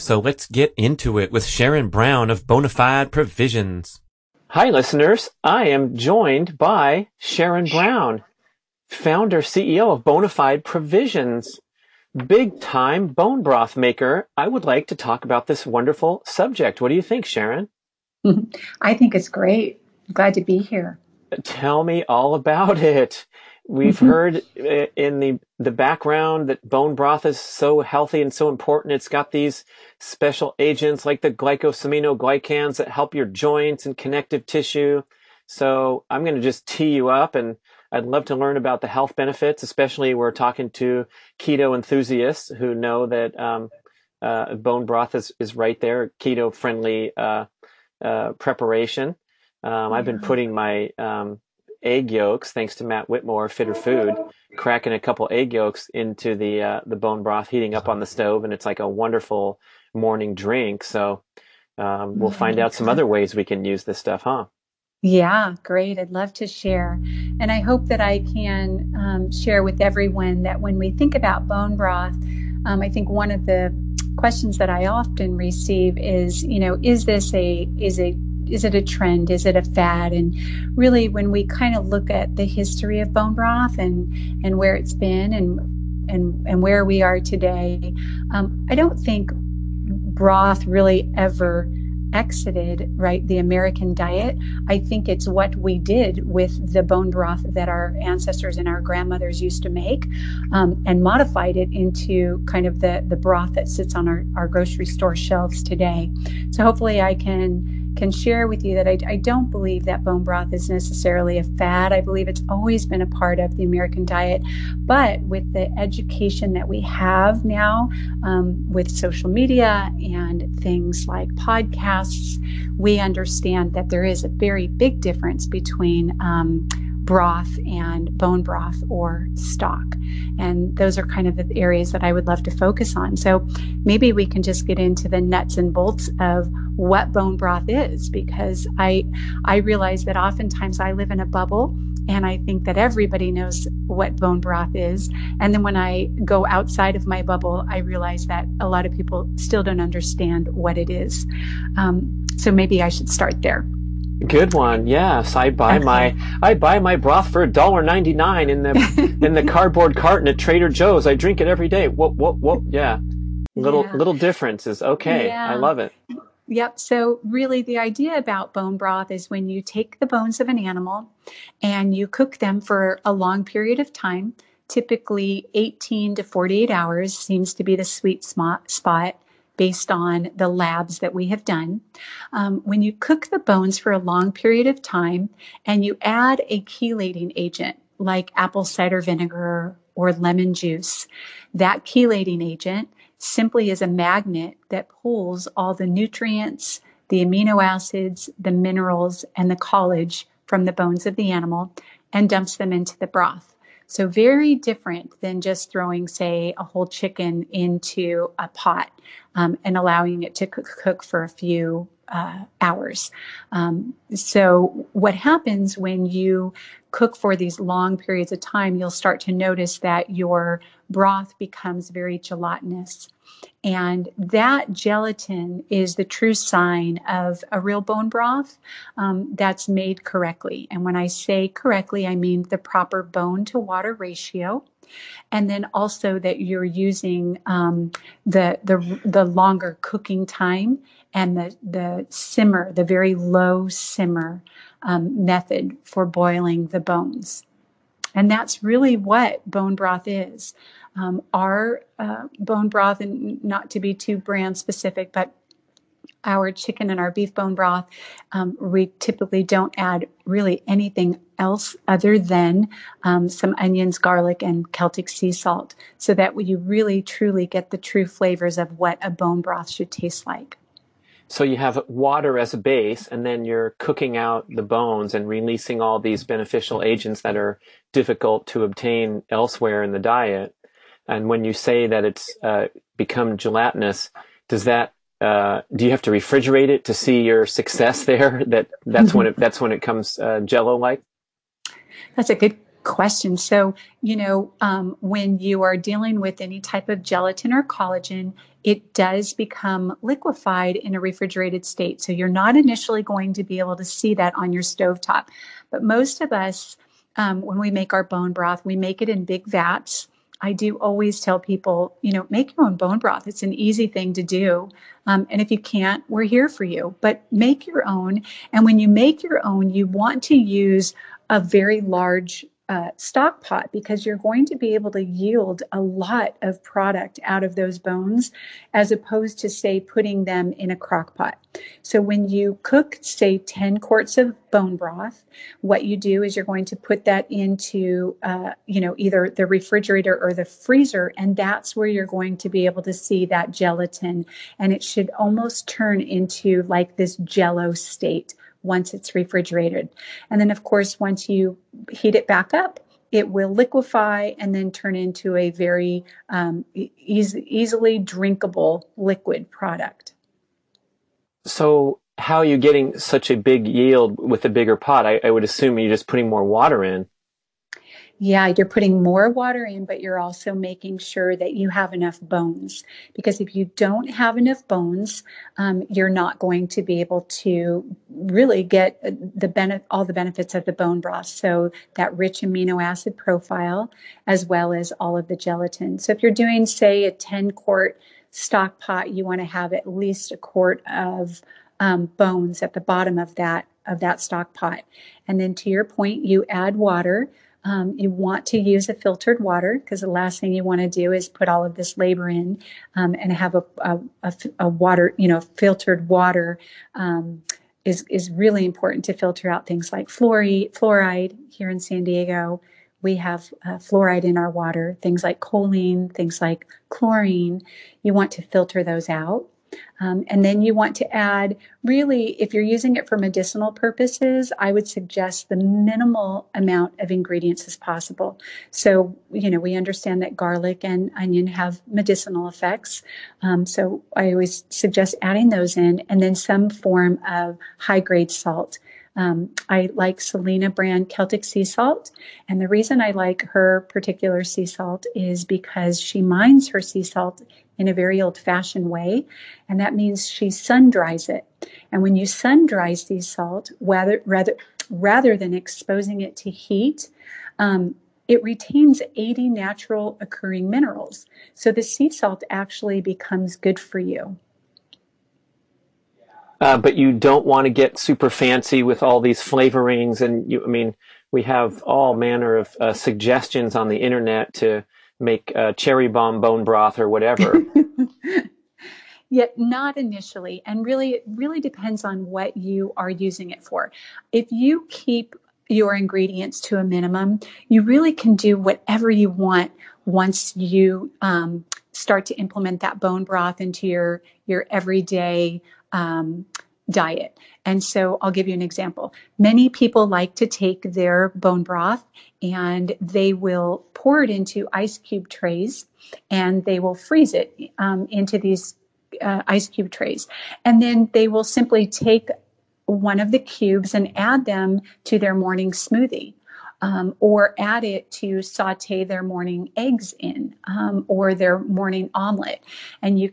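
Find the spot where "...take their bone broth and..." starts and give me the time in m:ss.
8:20.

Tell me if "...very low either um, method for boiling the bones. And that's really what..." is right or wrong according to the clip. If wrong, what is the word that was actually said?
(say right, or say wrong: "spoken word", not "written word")
wrong: "simmer", not "either".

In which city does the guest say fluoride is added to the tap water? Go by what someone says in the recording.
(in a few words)
San Diego.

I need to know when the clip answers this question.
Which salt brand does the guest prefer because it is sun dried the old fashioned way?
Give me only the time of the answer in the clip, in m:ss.
7:20.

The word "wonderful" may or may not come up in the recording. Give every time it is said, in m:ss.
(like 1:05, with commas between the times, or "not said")
0:15, 0:58.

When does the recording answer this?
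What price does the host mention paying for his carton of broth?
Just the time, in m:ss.
2:37.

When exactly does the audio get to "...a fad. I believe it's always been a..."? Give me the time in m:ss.
1:51.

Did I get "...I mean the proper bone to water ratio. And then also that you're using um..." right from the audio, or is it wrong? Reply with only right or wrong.
right.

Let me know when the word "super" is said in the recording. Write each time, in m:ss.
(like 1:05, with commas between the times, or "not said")
7:47.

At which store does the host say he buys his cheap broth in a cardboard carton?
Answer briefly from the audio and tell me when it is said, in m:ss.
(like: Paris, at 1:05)
Trader Joe's, at 2:40.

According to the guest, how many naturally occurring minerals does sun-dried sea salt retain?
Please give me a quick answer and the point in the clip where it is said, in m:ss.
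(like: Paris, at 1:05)
80, at 7:39.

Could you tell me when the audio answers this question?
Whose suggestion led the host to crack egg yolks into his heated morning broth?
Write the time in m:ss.
0:52.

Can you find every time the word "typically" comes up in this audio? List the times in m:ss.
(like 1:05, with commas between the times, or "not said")
2:54, 4:18.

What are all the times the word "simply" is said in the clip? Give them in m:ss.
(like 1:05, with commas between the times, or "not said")
3:13, 8:31.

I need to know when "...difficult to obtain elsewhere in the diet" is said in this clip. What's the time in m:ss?
4:37.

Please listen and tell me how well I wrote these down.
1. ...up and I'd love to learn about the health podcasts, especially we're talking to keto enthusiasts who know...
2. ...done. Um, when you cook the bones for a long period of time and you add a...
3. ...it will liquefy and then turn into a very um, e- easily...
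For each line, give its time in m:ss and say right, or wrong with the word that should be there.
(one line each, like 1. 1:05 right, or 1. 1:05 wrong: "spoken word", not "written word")
1. 0:37 wrong: "benefits", not "podcasts"
2. 3:01 right
3. 5:53 right.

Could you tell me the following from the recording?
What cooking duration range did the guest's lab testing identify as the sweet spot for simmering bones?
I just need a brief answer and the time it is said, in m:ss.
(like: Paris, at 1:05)
18 to 48 hours, at 2:55.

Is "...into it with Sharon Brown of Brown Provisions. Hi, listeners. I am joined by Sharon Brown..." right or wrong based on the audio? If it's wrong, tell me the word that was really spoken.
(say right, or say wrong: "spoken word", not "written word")
wrong: "Bonafide", not "Brown".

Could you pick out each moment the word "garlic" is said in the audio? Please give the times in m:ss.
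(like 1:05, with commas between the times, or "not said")
4:23, 7:10.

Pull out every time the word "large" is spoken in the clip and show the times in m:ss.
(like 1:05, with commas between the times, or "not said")
5:21.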